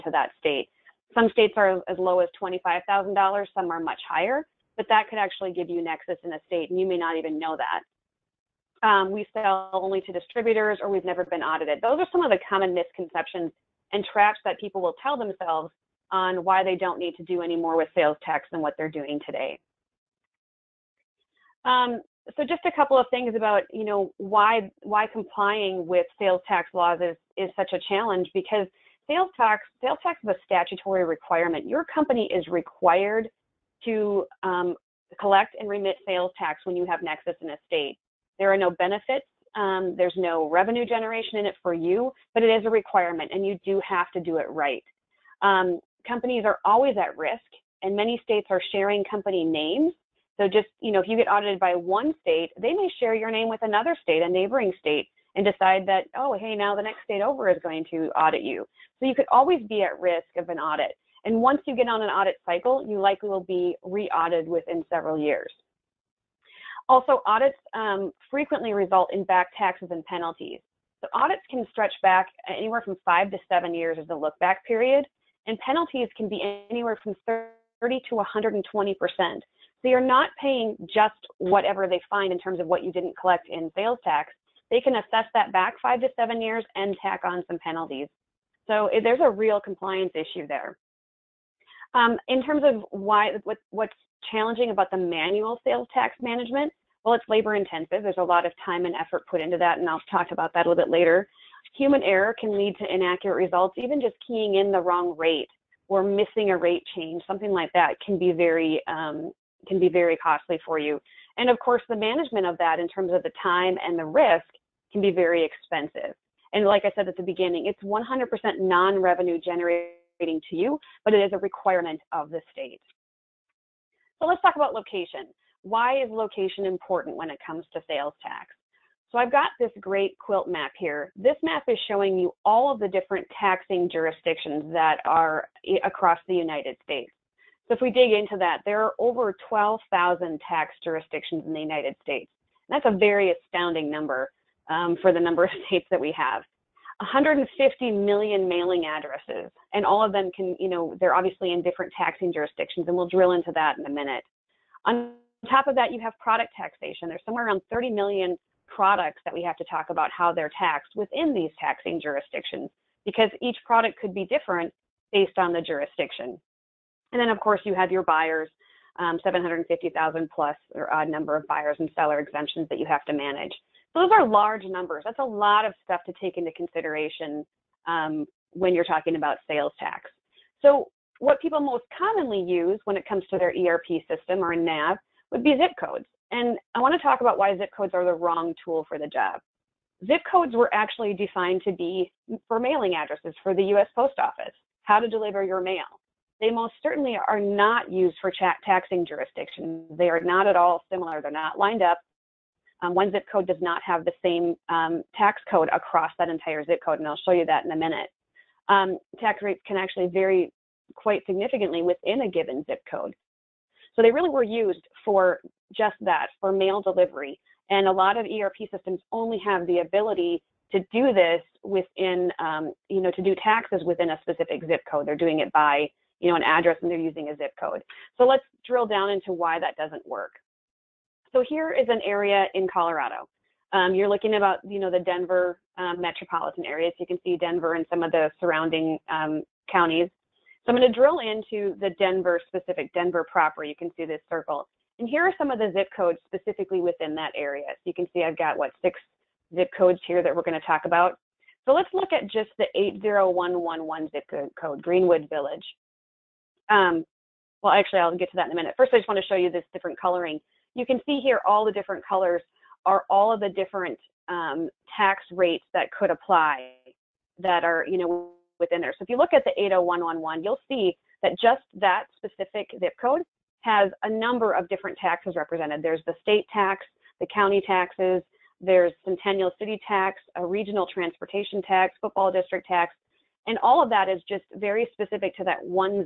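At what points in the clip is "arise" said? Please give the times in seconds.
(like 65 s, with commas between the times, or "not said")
not said.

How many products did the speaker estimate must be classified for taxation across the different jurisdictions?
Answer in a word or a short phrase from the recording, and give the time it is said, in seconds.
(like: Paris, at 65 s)
30 million, at 157 s.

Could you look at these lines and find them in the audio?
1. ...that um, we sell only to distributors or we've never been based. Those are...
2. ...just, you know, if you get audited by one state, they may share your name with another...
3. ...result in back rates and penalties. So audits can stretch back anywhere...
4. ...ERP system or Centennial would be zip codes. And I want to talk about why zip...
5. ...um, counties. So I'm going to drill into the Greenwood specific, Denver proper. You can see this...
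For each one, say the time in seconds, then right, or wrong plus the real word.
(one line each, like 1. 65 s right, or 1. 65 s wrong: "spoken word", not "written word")
1. 7 s wrong: "audited", not "based"
2. 50 s right
3. 68 s wrong: "taxes", not "rates"
4. 183 s wrong: "NAV", not "Centennial"
5. 239 s wrong: "Denver", not "Greenwood".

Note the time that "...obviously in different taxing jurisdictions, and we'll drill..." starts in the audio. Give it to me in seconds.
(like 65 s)
151 s.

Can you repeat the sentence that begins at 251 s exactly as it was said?
So let's look at just the 80111 zip code, Greenwood Village.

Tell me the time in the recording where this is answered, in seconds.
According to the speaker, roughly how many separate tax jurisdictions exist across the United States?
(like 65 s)
138 s.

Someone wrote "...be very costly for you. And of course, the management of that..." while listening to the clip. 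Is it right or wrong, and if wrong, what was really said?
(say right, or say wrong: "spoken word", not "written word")
right.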